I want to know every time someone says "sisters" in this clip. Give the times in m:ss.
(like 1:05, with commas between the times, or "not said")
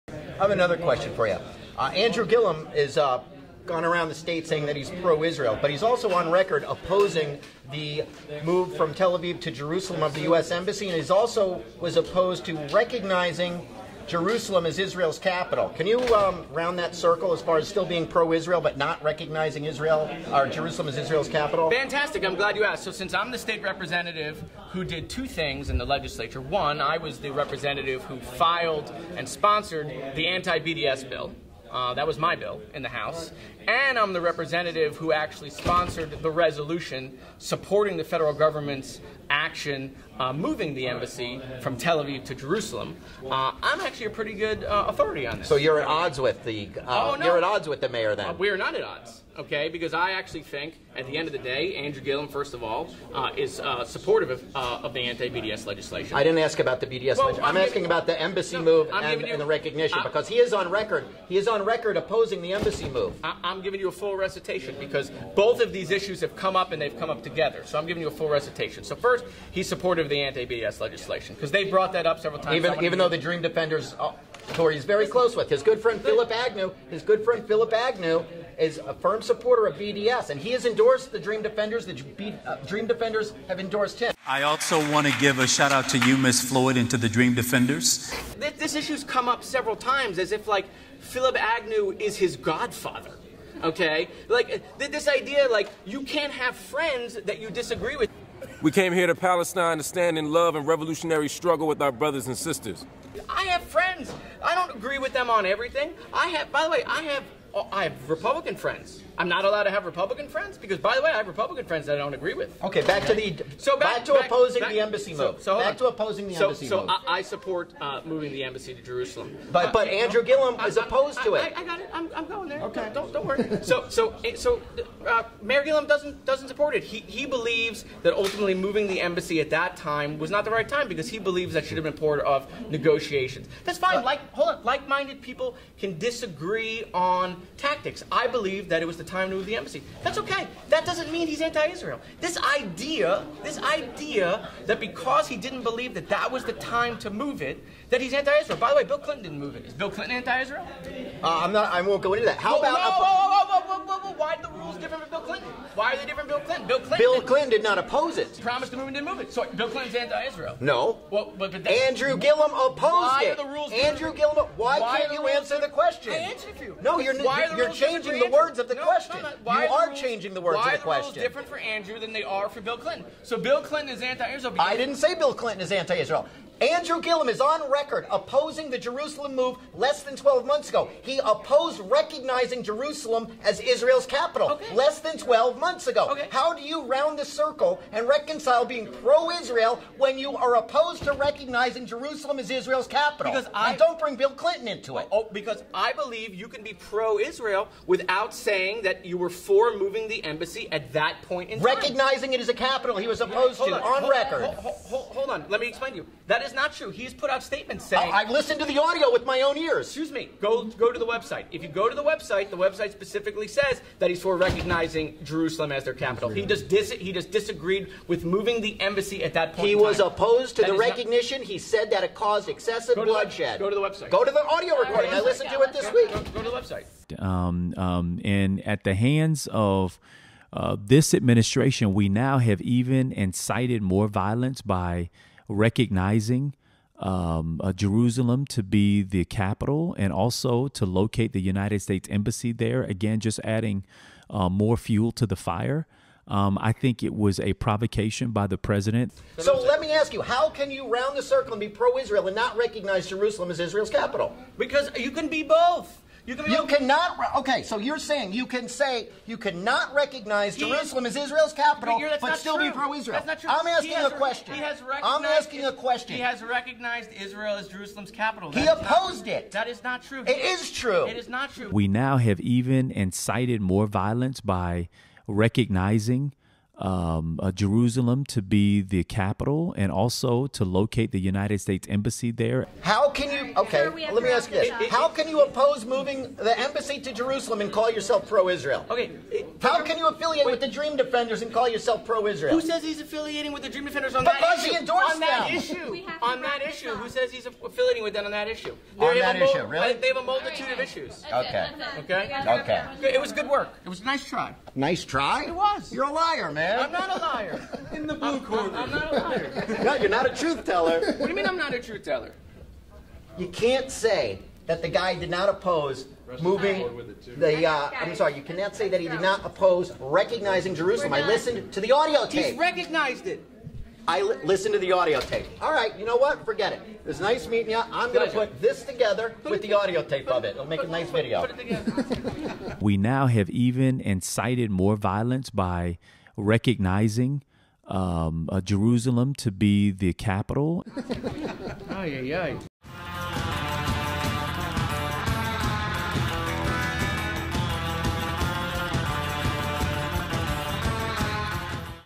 1:42.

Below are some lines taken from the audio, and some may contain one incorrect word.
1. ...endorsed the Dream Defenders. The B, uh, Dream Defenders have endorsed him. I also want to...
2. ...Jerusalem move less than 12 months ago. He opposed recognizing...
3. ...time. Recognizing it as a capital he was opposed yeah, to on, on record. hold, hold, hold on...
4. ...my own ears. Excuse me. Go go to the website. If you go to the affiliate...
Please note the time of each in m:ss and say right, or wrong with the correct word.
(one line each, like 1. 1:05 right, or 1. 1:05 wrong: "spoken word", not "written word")
1. 1:20 right
2. 2:58 right
3. 3:21 right
4. 3:29 wrong: "website", not "affiliate".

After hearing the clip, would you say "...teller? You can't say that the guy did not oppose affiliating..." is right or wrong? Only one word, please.
wrong.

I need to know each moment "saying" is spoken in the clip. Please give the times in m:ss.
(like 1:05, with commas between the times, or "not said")
0:04, 3:18, 3:27, 4:17.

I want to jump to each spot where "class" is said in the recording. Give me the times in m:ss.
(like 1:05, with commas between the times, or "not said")
not said.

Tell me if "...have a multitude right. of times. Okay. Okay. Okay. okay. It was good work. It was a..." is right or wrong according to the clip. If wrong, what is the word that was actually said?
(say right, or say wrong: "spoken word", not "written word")
wrong: "issues", not "times".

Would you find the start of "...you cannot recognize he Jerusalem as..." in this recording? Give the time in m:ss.
4:19.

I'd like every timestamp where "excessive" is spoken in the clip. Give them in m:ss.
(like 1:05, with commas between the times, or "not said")
3:42.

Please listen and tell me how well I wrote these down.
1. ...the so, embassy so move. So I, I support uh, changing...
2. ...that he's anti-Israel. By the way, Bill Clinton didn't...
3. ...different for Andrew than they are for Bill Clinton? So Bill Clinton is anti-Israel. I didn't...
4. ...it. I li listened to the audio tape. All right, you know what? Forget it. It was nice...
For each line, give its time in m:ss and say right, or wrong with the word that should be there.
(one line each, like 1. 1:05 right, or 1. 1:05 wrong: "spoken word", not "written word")
1. 1:56 wrong: "moving", not "changing"
2. 2:27 right
3. 2:51 right
4. 5:23 right.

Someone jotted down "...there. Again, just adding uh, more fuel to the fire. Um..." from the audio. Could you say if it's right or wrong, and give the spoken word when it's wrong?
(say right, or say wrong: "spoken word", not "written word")
right.